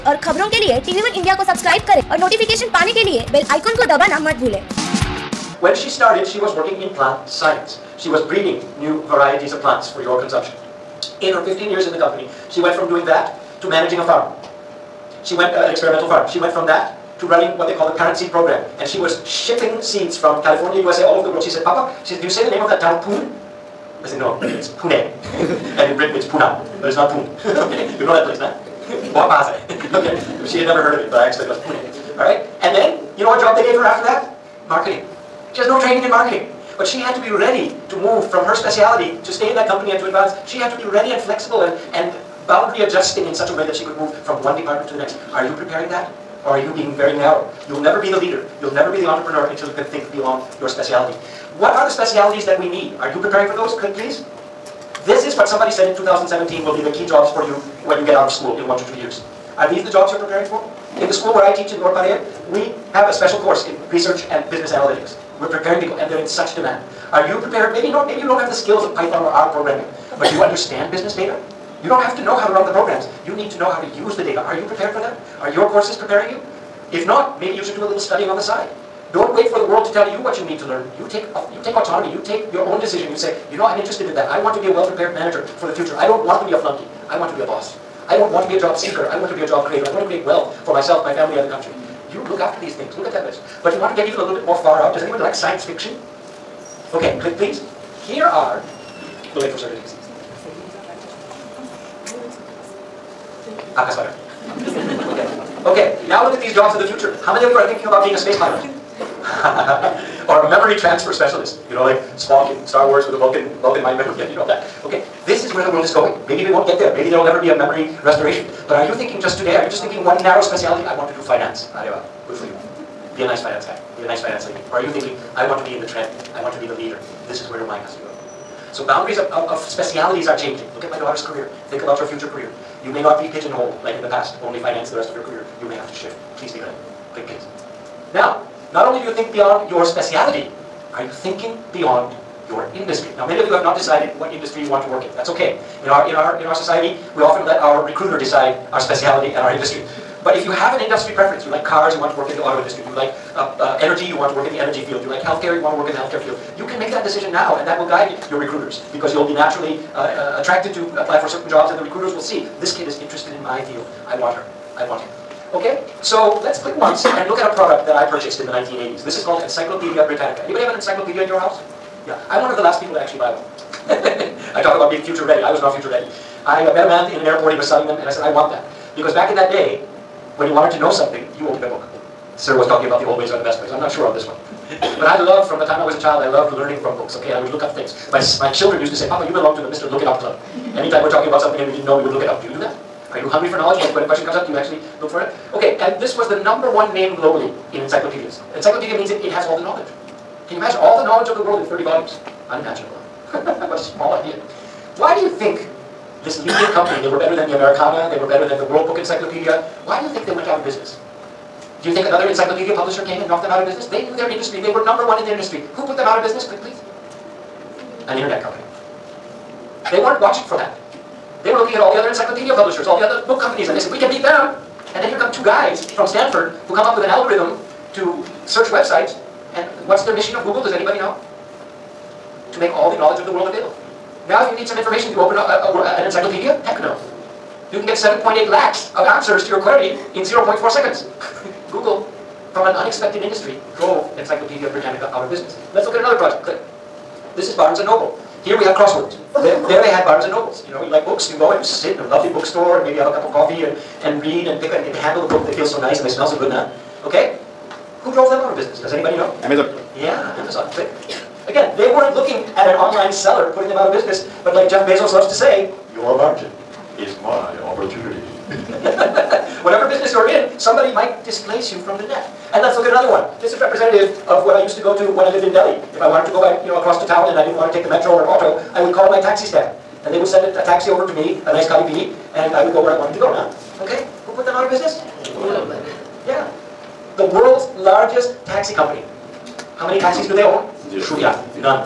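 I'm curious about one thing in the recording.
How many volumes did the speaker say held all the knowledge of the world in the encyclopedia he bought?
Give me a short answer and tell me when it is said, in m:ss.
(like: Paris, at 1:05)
30, at 3:21.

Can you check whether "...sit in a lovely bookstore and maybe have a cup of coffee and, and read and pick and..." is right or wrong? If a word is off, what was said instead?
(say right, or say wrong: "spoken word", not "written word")
right.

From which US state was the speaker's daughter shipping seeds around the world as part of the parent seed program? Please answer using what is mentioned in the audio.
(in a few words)
California.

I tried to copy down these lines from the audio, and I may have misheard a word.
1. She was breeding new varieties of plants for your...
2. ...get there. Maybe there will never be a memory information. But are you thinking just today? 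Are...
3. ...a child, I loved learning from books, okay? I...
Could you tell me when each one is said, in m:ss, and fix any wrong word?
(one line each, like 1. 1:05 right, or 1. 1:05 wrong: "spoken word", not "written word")
1. 0:08 right
2. 1:56 wrong: "restoration", not "information"
3. 3:05 right.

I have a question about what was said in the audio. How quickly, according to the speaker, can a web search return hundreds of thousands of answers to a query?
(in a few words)
0.4 seconds.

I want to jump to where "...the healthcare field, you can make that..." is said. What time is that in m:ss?
2:35.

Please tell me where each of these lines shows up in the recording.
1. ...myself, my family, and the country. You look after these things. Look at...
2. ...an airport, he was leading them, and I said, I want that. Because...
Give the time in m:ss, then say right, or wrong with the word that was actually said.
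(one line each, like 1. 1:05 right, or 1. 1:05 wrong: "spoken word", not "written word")
1. 1:30 right
2. 2:57 wrong: "selling", not "leading".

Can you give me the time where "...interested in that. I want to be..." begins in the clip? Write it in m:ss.
1:23.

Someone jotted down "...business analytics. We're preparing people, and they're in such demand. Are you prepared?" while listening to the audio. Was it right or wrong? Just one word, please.
right.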